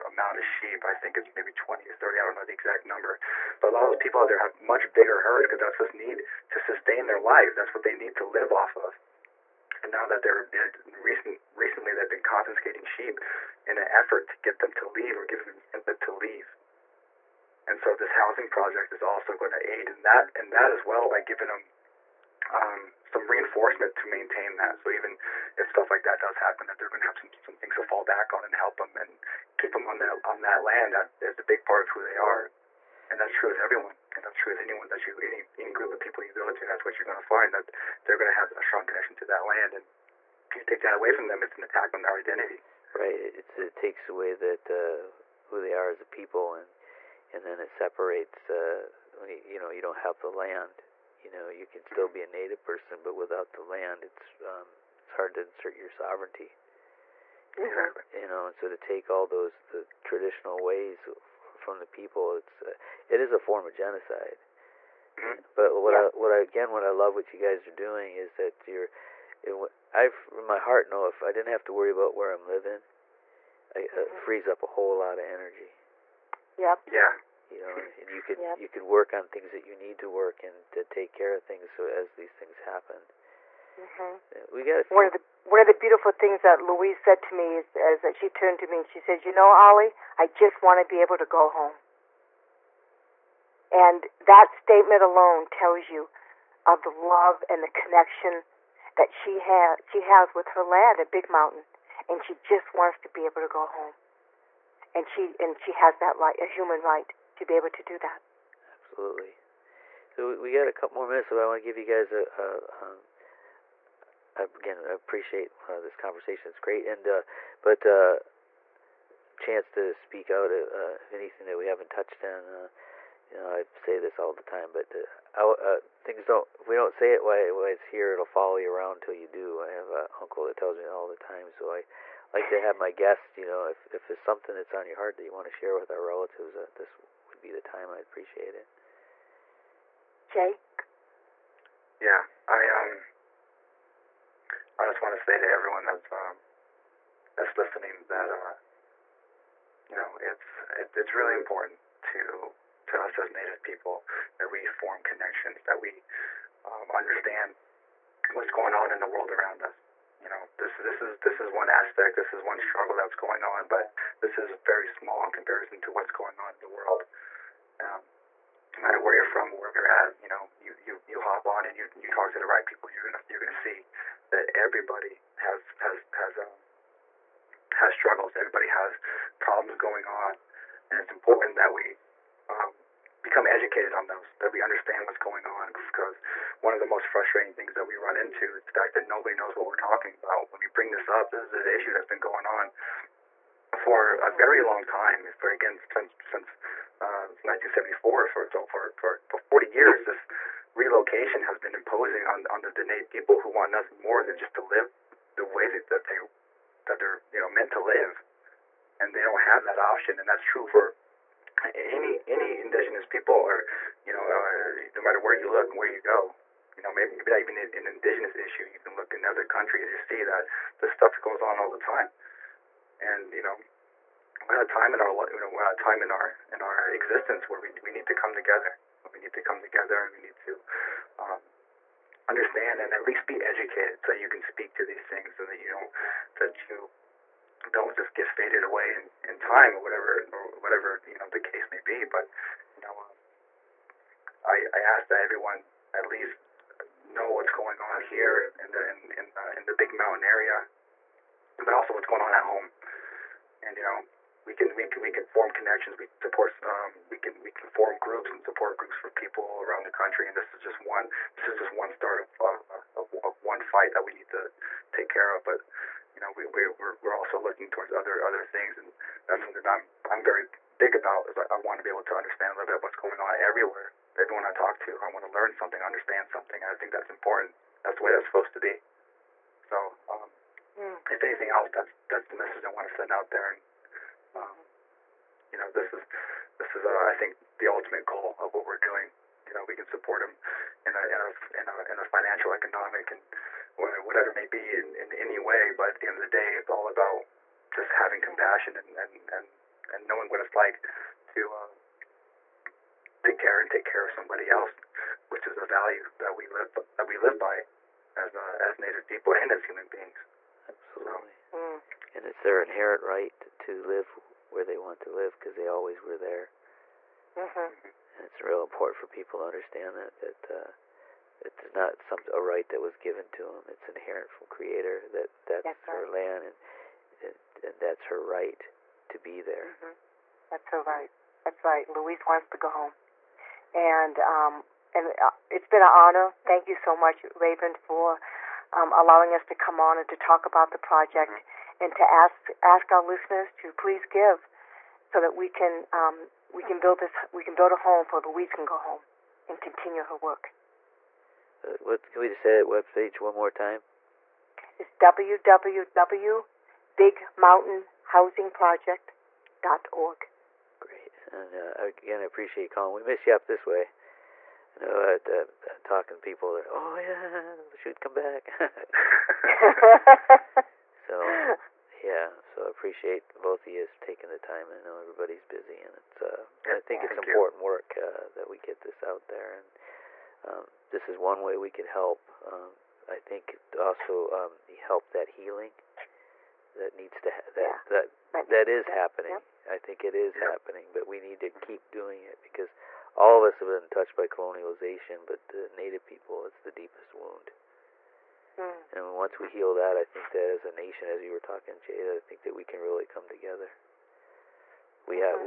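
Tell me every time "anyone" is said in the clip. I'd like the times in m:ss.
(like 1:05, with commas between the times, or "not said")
0:34.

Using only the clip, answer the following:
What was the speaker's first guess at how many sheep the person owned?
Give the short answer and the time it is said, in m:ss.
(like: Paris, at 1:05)
20 or 30, at 0:01.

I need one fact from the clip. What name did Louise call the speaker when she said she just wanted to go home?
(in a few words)
Ollie.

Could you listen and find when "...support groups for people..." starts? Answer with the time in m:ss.
4:18.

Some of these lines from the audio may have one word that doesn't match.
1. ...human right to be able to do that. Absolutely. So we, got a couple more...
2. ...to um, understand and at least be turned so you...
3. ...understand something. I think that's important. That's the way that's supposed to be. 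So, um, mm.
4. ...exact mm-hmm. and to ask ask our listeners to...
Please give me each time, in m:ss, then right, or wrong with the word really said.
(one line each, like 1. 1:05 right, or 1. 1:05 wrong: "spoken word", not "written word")
1. 1:46 right
2. 3:50 wrong: "educated", not "turned"
3. 4:35 right
4. 5:40 wrong: "project", not "exact".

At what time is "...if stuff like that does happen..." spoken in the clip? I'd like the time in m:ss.
0:25.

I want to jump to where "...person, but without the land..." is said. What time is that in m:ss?
0:52.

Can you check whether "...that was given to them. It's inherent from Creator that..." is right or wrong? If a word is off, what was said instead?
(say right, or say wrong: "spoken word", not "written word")
right.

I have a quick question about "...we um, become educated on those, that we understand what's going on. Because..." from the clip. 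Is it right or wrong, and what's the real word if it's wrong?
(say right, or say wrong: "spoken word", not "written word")
right.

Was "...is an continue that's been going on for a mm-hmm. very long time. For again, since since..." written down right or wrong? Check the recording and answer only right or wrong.
wrong.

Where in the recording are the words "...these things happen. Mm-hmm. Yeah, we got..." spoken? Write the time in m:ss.
1:22.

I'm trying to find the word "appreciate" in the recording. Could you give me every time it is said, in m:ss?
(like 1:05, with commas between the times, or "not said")
1:54, 2:18, 6:02, 6:12.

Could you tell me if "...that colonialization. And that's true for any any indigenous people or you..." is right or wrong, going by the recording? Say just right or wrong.
wrong.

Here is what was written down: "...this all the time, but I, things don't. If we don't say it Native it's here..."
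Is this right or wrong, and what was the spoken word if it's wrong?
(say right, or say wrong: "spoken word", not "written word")
wrong: "Why", not "Native".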